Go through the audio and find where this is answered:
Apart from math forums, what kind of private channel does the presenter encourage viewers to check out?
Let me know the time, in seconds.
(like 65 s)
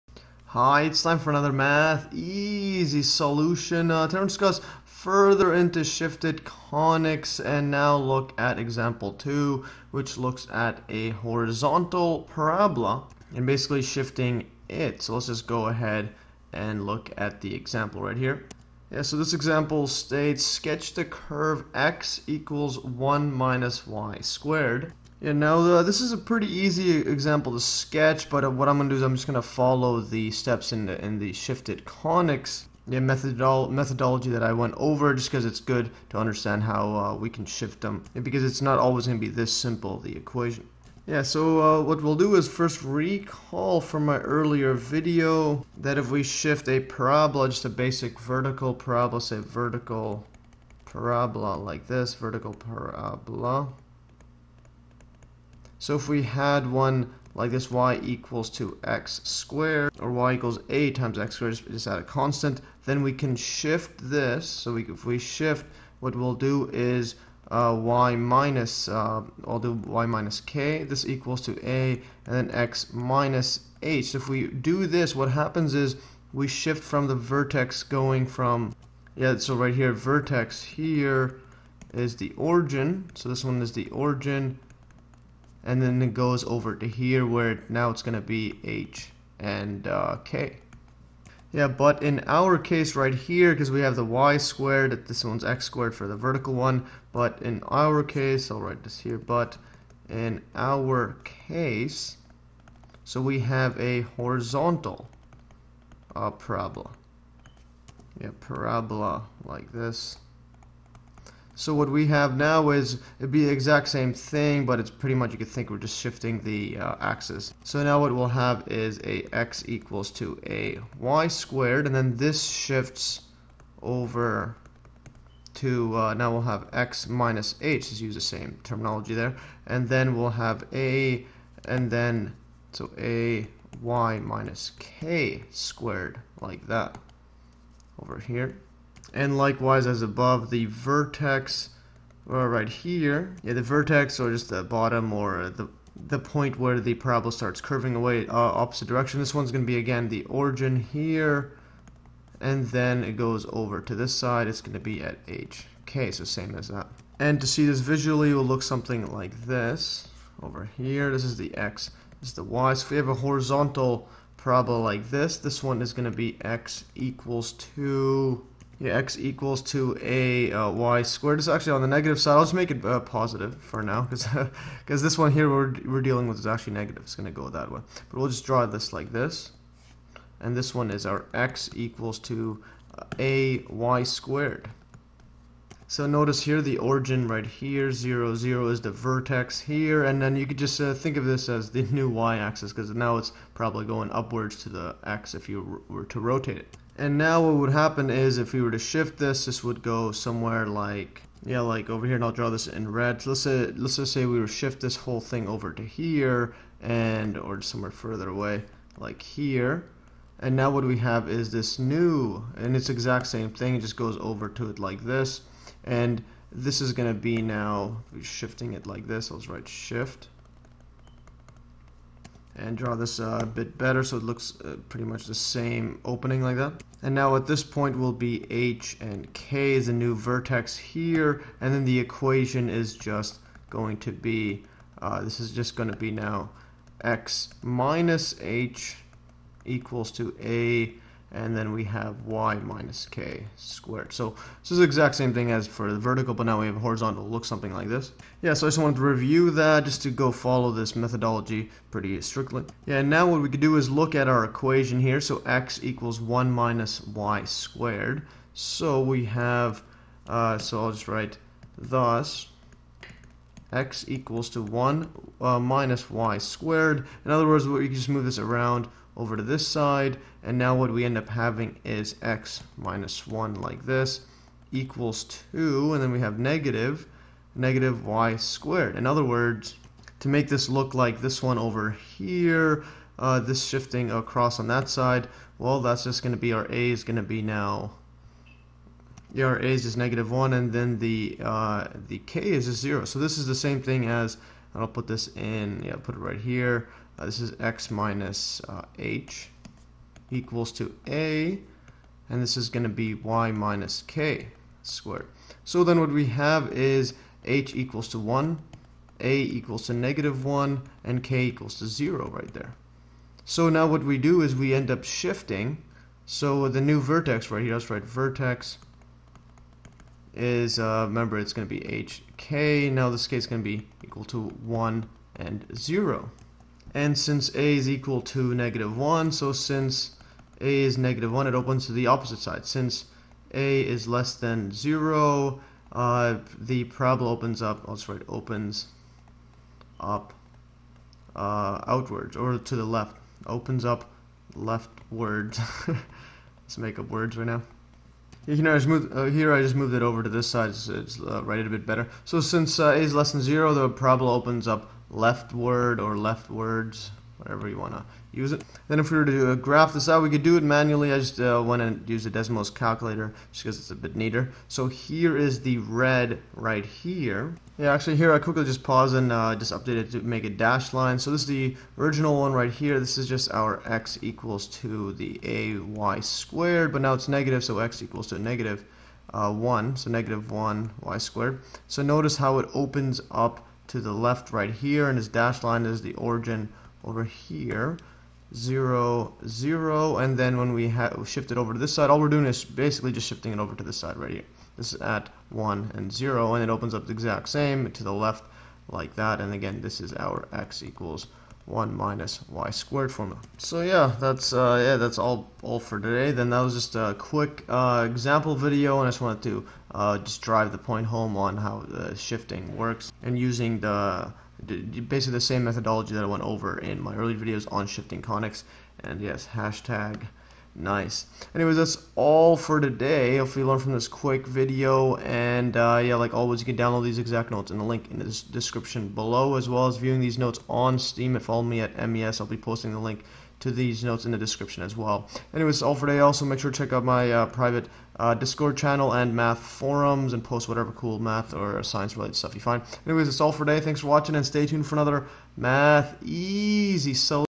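438 s.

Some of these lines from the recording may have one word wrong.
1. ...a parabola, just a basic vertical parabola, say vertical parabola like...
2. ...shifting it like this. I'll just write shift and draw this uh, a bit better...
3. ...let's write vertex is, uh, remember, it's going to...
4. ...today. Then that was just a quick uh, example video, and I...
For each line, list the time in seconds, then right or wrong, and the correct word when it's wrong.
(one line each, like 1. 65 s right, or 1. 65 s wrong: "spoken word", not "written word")
1. 46 s right
2. 218 s right
3. 317 s right
4. 405 s right.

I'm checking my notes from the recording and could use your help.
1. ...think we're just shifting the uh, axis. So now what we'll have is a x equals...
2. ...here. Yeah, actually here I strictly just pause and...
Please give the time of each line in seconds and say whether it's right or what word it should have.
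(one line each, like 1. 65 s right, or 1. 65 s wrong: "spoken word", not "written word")
1. 115 s right
2. 366 s wrong: "quickly", not "strictly".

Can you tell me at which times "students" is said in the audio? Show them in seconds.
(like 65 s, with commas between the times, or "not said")
not said.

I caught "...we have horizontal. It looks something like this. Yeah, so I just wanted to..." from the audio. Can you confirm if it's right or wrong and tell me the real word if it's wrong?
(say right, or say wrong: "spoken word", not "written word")
right.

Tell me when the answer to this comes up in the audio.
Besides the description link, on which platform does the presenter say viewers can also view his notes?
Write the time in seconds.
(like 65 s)
430 s.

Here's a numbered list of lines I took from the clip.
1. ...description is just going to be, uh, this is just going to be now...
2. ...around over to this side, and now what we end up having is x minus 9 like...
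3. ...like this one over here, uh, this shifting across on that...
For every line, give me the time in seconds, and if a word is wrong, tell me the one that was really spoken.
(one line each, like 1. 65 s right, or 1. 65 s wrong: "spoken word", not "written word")
1. 231 s wrong: "equation", not "description"
2. 268 s wrong: "1", not "9"
3. 280 s right.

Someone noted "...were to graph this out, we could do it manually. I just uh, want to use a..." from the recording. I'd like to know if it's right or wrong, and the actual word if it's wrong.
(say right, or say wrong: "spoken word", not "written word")
right.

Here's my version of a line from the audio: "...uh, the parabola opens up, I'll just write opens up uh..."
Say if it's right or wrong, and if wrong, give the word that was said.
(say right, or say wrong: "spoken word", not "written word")
right.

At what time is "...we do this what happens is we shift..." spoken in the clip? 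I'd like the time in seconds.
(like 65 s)
74 s.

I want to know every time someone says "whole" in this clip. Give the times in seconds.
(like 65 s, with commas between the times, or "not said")
204 s.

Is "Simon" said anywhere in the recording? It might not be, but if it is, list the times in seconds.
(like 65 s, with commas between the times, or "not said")
not said.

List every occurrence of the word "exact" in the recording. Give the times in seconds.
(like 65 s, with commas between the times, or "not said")
113 s, 212 s, 244 s, 397 s, 427 s.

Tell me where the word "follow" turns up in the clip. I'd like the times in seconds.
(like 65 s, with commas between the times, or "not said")
29 s, 250 s, 431 s.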